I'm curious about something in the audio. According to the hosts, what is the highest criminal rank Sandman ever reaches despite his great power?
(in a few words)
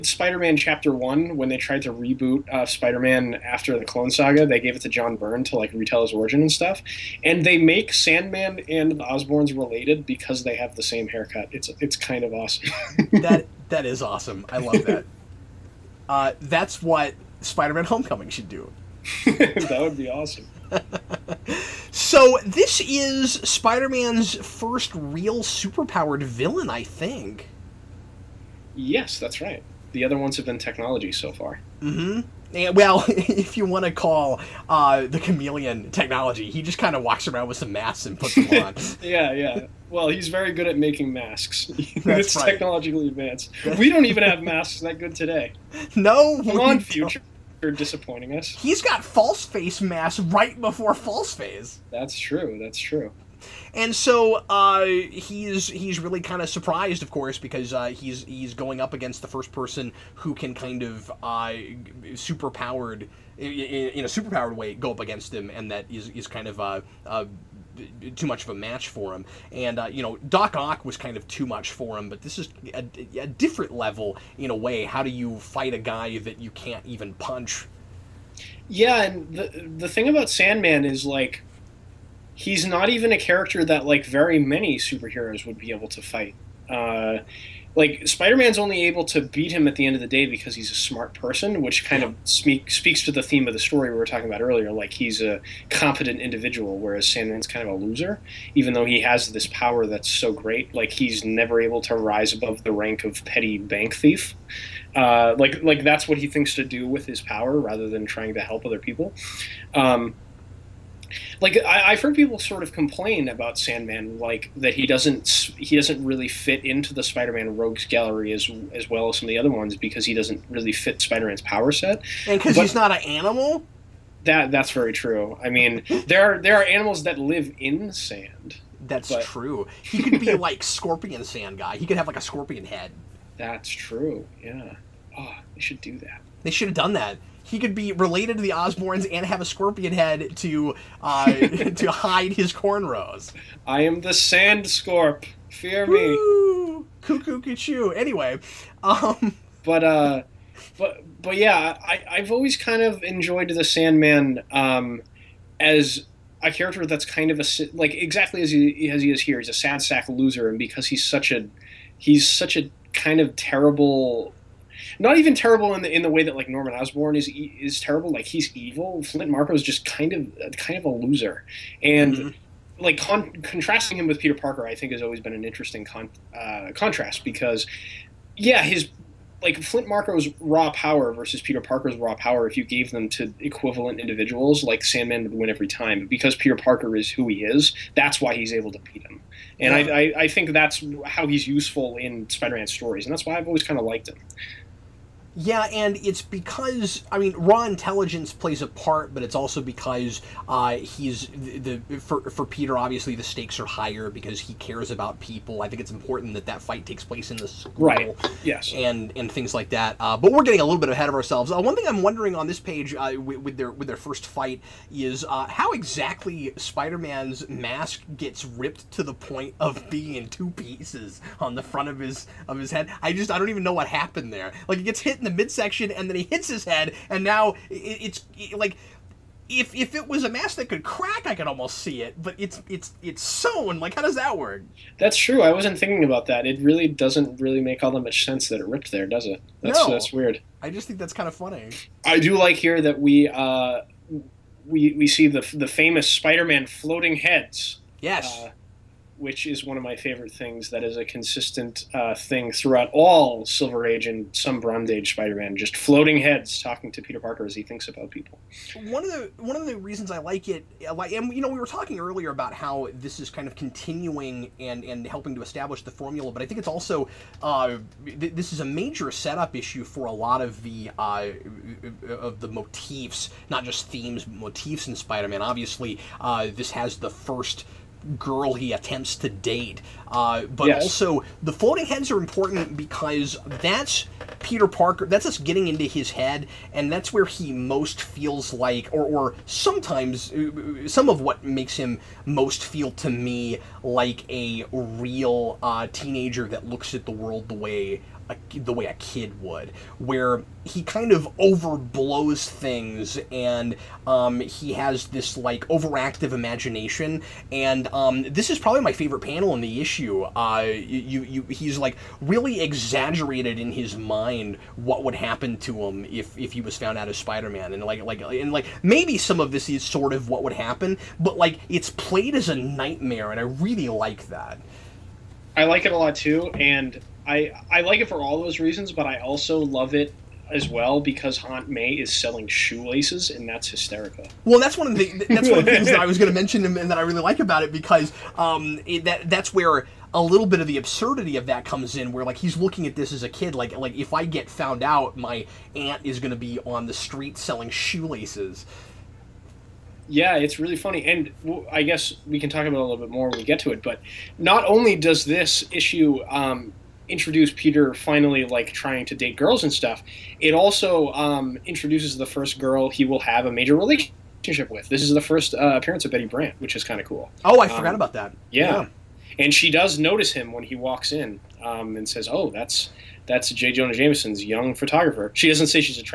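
petty bank thief.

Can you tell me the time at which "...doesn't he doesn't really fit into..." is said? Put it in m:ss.
1:54.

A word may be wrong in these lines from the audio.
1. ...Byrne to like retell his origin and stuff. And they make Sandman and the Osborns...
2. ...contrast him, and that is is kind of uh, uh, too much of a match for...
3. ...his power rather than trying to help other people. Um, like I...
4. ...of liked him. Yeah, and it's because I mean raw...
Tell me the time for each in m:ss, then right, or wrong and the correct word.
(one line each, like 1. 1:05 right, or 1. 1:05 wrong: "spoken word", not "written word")
1. 0:05 right
2. 1:05 wrong: "against", not "contrast"
3. 1:47 right
4. 3:13 right.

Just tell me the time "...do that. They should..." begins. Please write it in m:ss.
2:15.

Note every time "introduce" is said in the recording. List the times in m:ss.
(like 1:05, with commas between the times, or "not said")
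5:57, 6:01.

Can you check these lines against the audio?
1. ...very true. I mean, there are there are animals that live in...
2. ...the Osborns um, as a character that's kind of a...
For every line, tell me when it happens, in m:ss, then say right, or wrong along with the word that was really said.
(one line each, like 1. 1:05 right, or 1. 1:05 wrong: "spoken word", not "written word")
1. 2:04 right
2. 2:33 wrong: "Sandman", not "Osborns".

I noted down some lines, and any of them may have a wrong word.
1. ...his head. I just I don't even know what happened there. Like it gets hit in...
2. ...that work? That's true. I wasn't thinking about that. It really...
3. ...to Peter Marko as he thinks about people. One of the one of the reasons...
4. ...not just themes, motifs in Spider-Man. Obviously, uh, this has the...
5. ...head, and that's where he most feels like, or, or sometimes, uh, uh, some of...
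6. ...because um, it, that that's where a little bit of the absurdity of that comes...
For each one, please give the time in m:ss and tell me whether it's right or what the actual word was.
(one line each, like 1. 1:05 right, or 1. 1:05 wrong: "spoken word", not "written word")
1. 3:42 right
2. 3:54 right
3. 4:16 wrong: "Parker", not "Marko"
4. 4:33 right
5. 4:46 right
6. 5:37 right.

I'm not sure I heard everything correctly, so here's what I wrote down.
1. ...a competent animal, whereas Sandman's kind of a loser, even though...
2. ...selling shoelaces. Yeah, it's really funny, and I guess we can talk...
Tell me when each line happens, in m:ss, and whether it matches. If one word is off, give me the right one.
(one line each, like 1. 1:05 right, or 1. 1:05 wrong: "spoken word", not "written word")
1. 1:35 wrong: "individual", not "animal"
2. 5:47 right.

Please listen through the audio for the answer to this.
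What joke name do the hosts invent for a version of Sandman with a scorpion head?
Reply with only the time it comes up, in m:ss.
2:24.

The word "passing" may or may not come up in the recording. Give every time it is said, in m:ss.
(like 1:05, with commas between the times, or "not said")
not said.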